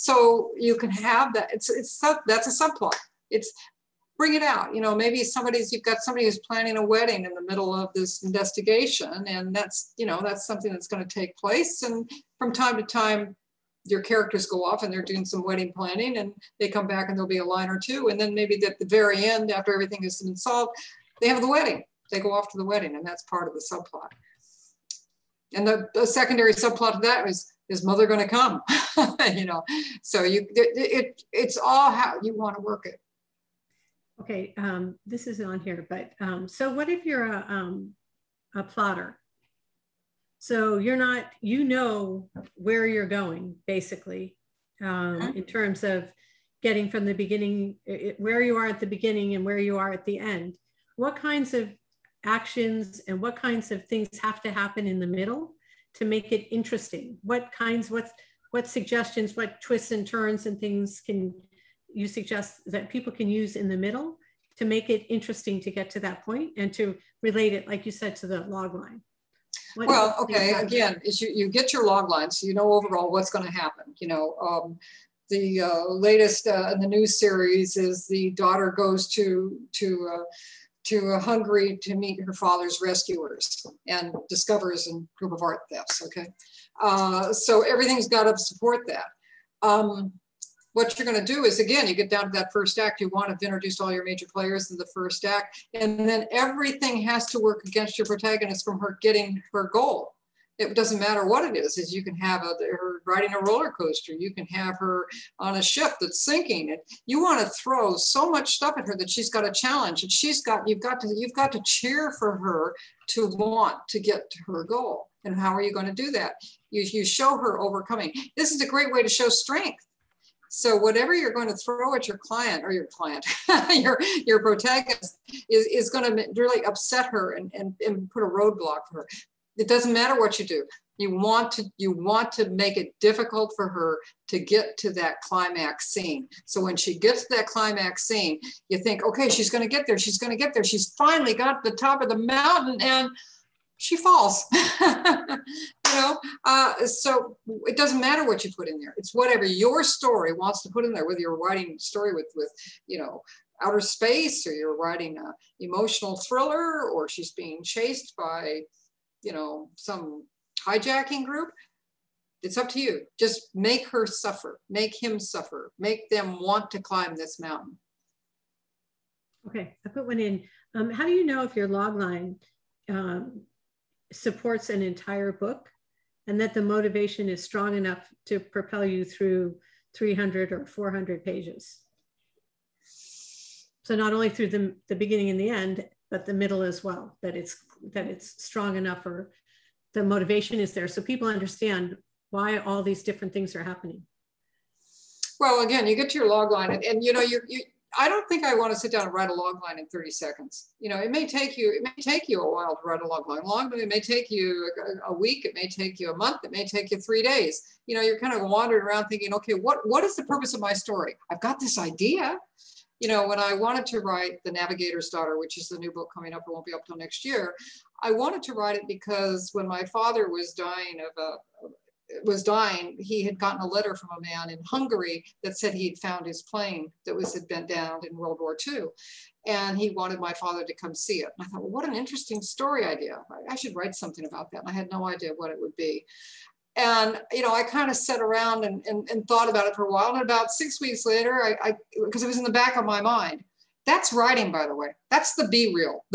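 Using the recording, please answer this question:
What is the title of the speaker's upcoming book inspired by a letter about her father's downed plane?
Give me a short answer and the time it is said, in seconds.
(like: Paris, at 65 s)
The Navigator's Daughter, at 214 s.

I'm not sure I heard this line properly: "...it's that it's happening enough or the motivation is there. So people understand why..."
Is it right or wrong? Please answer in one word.
wrong.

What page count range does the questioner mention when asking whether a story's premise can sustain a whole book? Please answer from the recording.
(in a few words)
300 or 400 pages.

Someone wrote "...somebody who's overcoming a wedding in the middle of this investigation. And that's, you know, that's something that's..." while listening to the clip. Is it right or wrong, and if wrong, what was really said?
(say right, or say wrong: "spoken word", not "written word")
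wrong: "planning", not "overcoming".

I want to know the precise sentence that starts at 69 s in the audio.
What well, okay, again, is you, you get your log line so you know overall what's going to happen.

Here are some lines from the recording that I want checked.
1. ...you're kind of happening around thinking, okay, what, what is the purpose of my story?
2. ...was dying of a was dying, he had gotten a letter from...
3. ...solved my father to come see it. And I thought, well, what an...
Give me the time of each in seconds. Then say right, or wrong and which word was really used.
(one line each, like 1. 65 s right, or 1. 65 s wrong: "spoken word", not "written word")
1. 208 s wrong: "wandering", not "happening"
2. 220 s right
3. 229 s wrong: "wanted", not "solved".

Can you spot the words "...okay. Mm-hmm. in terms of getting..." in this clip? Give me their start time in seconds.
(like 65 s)
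45 s.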